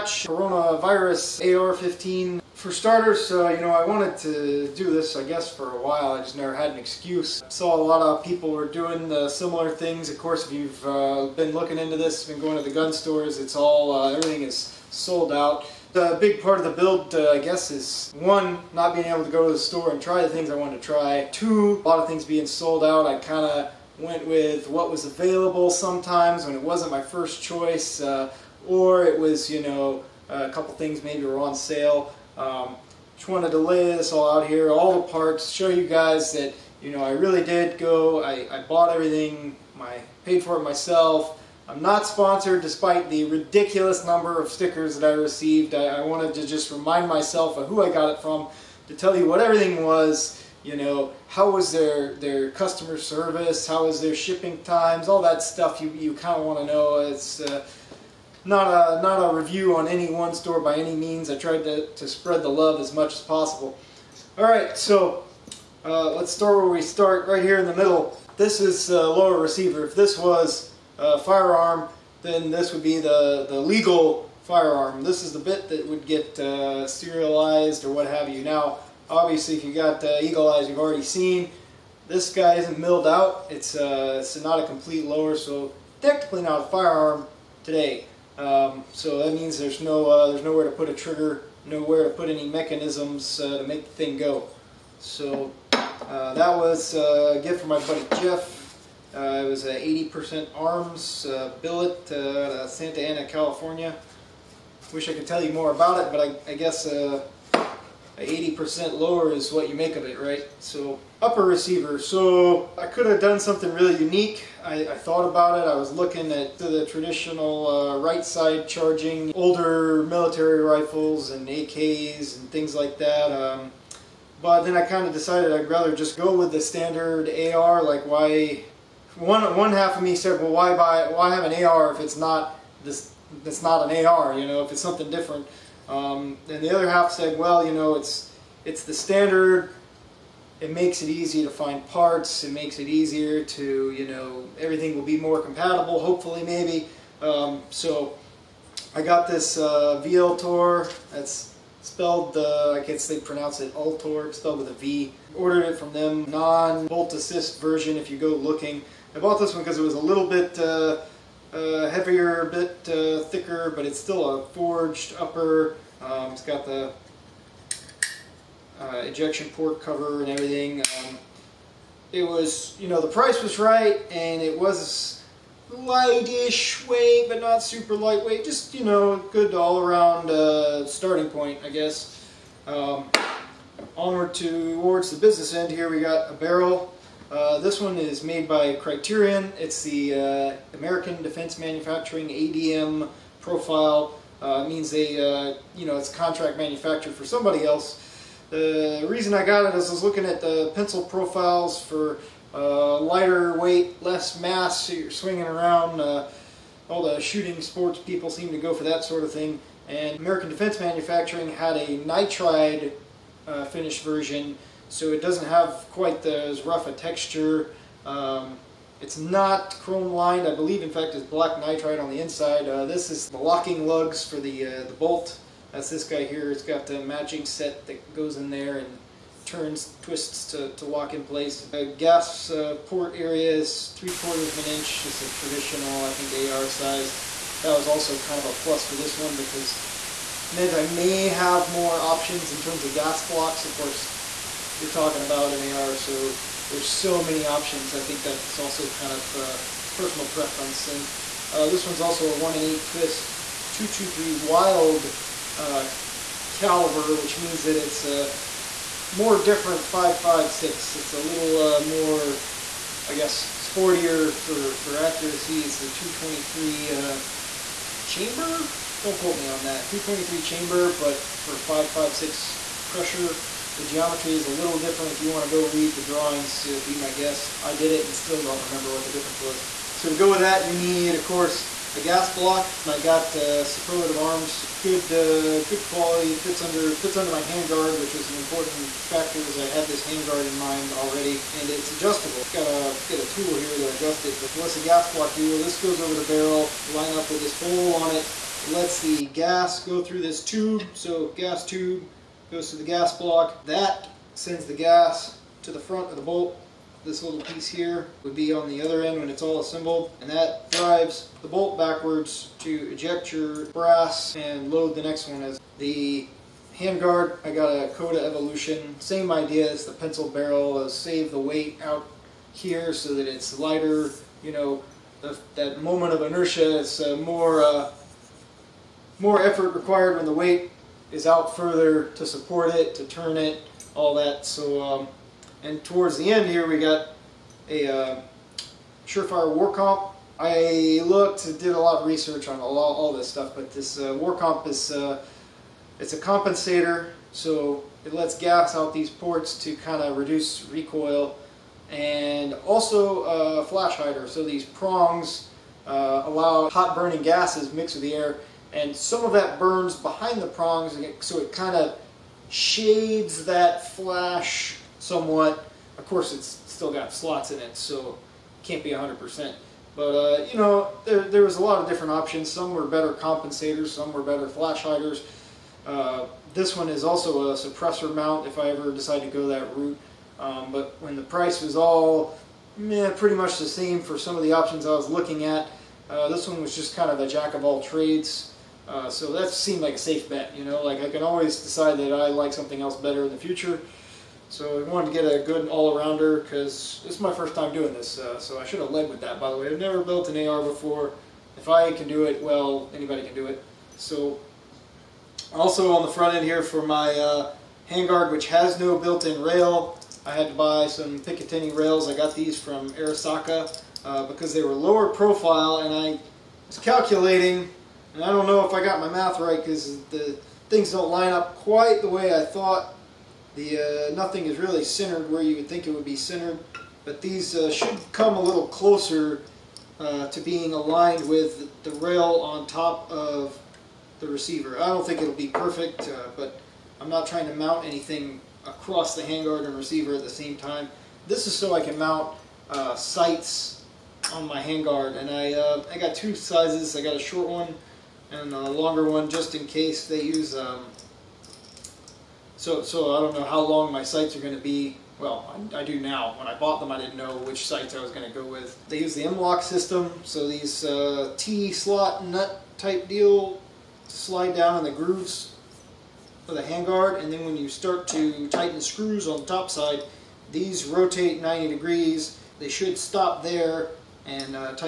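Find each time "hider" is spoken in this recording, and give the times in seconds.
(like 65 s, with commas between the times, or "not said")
353 s, 374 s.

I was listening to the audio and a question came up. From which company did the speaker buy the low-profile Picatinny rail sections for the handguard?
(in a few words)
Arisaka.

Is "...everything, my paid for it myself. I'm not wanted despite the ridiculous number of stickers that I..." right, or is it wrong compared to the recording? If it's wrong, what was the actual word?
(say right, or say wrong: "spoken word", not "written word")
wrong: "sponsored", not "wanted".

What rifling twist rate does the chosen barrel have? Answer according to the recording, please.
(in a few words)
1 in 8.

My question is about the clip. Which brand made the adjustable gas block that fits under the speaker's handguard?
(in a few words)
Superlative Arms.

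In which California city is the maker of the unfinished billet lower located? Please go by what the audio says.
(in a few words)
Santa Ana.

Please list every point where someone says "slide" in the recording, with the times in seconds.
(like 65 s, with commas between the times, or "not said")
464 s.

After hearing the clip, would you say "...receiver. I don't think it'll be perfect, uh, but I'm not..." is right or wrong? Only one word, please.
right.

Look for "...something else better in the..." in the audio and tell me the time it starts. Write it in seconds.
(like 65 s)
392 s.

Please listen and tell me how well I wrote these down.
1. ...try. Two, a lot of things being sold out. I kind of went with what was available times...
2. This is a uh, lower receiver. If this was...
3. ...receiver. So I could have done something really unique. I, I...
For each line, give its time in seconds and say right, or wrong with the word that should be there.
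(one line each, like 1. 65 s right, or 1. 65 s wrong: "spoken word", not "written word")
1. 20 s wrong: "sometimes", not "times"
2. 68 s right
3. 111 s right.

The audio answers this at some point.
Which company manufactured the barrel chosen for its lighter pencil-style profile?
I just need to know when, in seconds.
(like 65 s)
188 s.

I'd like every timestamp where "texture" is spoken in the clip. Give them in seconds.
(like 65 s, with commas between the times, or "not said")
216 s.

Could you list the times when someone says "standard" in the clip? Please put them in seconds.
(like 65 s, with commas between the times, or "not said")
126 s, 138 s.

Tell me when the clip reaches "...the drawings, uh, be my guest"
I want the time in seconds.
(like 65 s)
275 s.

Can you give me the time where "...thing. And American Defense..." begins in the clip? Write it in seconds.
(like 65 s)
209 s.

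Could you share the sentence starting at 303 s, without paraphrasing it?
That sends the gas to the front of the bolt.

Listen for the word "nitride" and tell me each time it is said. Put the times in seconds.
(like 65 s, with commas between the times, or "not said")
211 s, 221 s.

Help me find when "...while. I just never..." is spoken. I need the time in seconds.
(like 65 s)
5 s.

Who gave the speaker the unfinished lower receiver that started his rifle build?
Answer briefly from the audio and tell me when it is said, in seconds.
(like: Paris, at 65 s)
Jeff, at 97 s.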